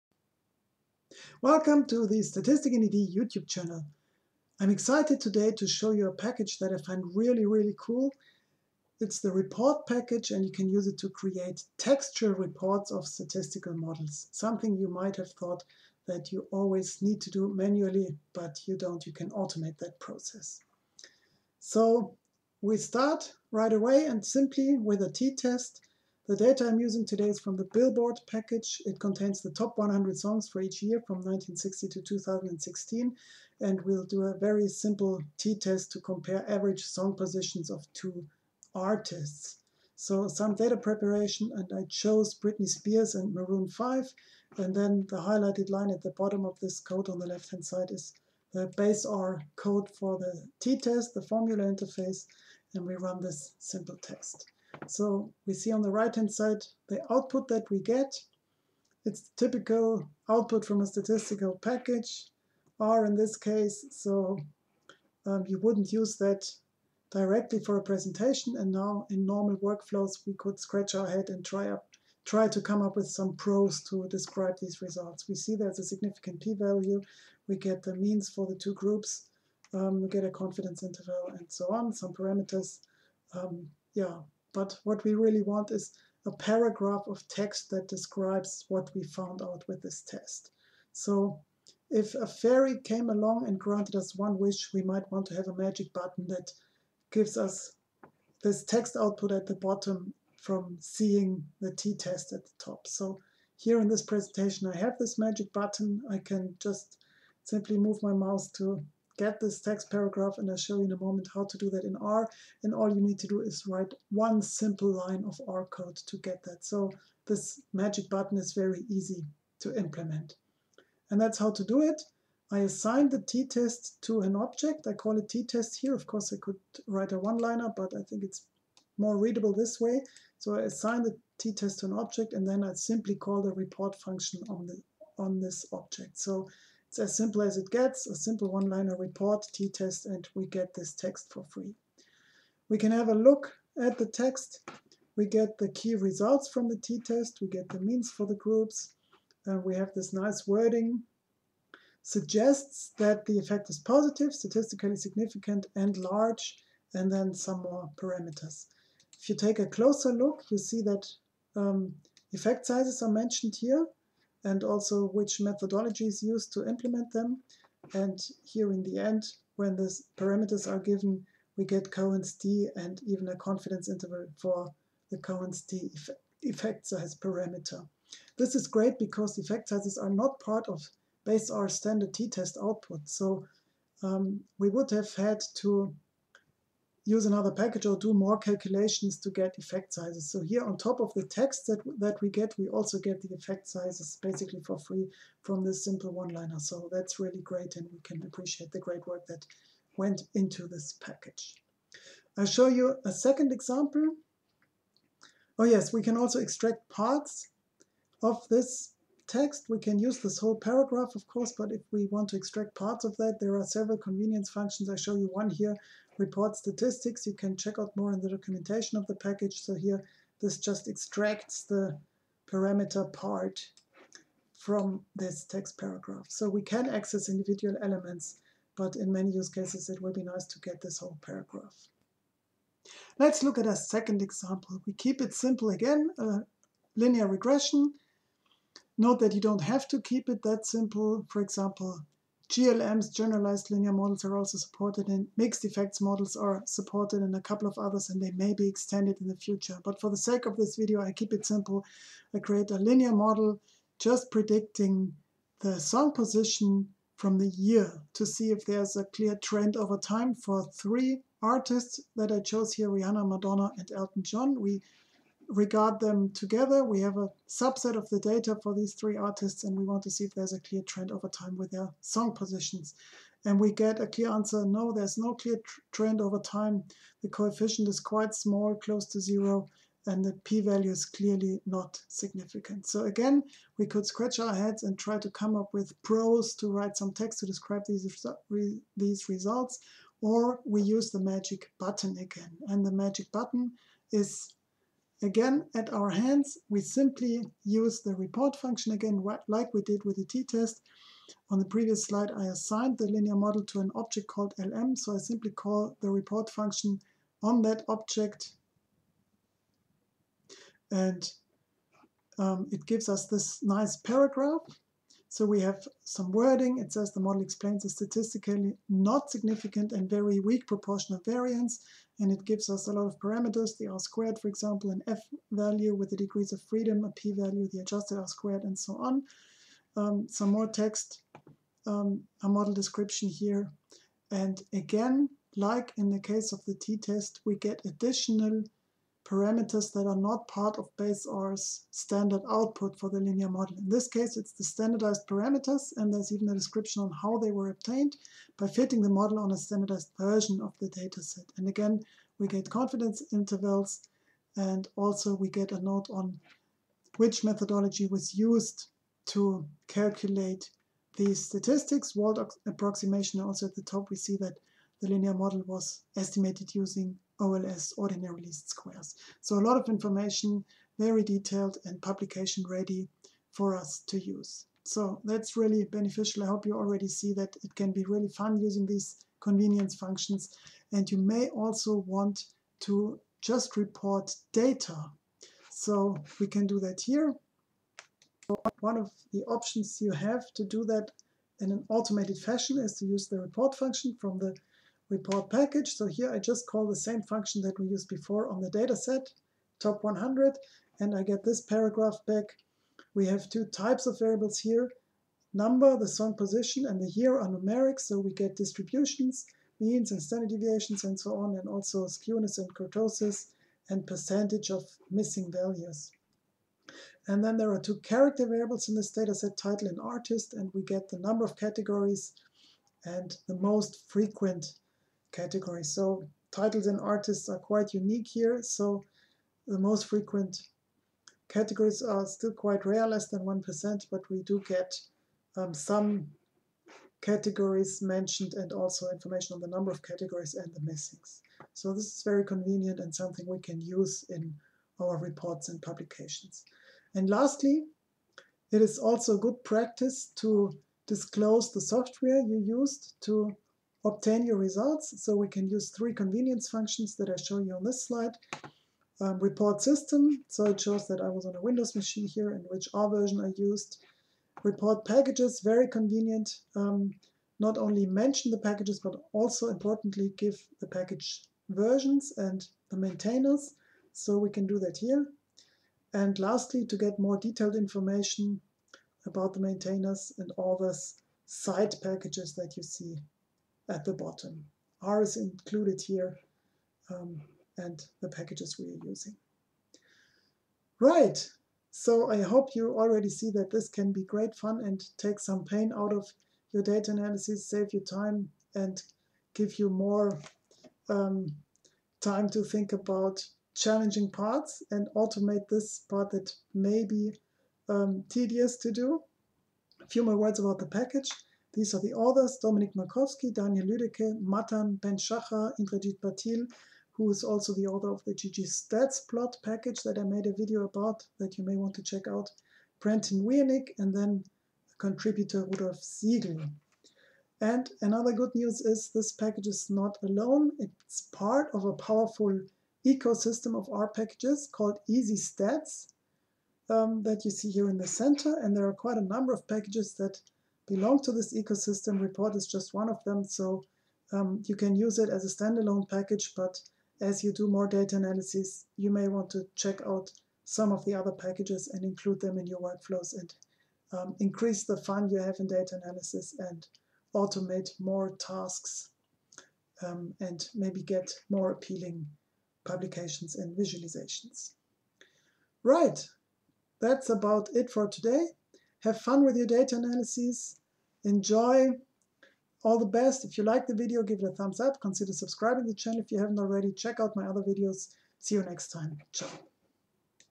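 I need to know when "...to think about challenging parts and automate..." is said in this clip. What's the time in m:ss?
8:22.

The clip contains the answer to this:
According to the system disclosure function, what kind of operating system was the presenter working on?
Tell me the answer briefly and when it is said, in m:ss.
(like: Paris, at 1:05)
Windows, at 7:41.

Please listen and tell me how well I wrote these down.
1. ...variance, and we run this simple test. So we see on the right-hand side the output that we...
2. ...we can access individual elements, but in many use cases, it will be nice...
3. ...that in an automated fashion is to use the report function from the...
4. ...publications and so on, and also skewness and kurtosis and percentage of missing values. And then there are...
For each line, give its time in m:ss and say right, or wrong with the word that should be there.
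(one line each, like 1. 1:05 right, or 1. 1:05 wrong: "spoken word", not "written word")
1. 0:51 wrong: "interface", not "variance"
2. 3:46 right
3. 6:30 right
4. 6:50 wrong: "deviations", not "publications".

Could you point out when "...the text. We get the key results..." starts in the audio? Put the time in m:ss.
2:23.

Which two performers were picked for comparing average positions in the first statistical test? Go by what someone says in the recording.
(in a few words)
Britney Spears and Maroon 5.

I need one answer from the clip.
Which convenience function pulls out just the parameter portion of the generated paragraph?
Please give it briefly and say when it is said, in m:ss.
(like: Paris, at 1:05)
report statistics, at 3:36.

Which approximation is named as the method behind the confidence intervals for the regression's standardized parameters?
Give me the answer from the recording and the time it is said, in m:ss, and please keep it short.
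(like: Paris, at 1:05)
Wald approximation, at 6:02.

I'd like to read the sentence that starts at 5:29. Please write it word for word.
Um, some more text, um, a model description here.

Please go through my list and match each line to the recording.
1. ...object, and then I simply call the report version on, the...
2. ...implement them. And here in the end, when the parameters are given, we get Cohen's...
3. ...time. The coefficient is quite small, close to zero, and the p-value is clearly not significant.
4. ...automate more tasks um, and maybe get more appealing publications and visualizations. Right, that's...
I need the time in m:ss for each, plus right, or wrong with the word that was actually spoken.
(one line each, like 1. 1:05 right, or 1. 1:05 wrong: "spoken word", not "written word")
1. 2:11 wrong: "function", not "version"
2. 2:46 right
3. 4:36 right
4. 9:17 right.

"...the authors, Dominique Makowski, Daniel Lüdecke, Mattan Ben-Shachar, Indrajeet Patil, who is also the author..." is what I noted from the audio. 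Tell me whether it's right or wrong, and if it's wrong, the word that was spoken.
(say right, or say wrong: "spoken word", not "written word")
right.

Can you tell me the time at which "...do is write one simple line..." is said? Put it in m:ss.
1:53.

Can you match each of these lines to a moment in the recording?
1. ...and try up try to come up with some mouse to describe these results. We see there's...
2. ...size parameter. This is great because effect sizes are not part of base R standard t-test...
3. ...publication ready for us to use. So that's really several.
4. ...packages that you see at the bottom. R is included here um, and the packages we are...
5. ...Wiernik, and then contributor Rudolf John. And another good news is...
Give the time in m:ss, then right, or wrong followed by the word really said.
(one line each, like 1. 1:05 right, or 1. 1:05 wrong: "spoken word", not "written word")
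1. 1:11 wrong: "prose", not "mouse"
2. 2:56 right
3. 6:11 wrong: "beneficial", not "several"
4. 8:02 right
5. 8:43 wrong: "Siegel", not "John".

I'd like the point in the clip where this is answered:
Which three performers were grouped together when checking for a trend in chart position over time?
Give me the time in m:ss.
4:22.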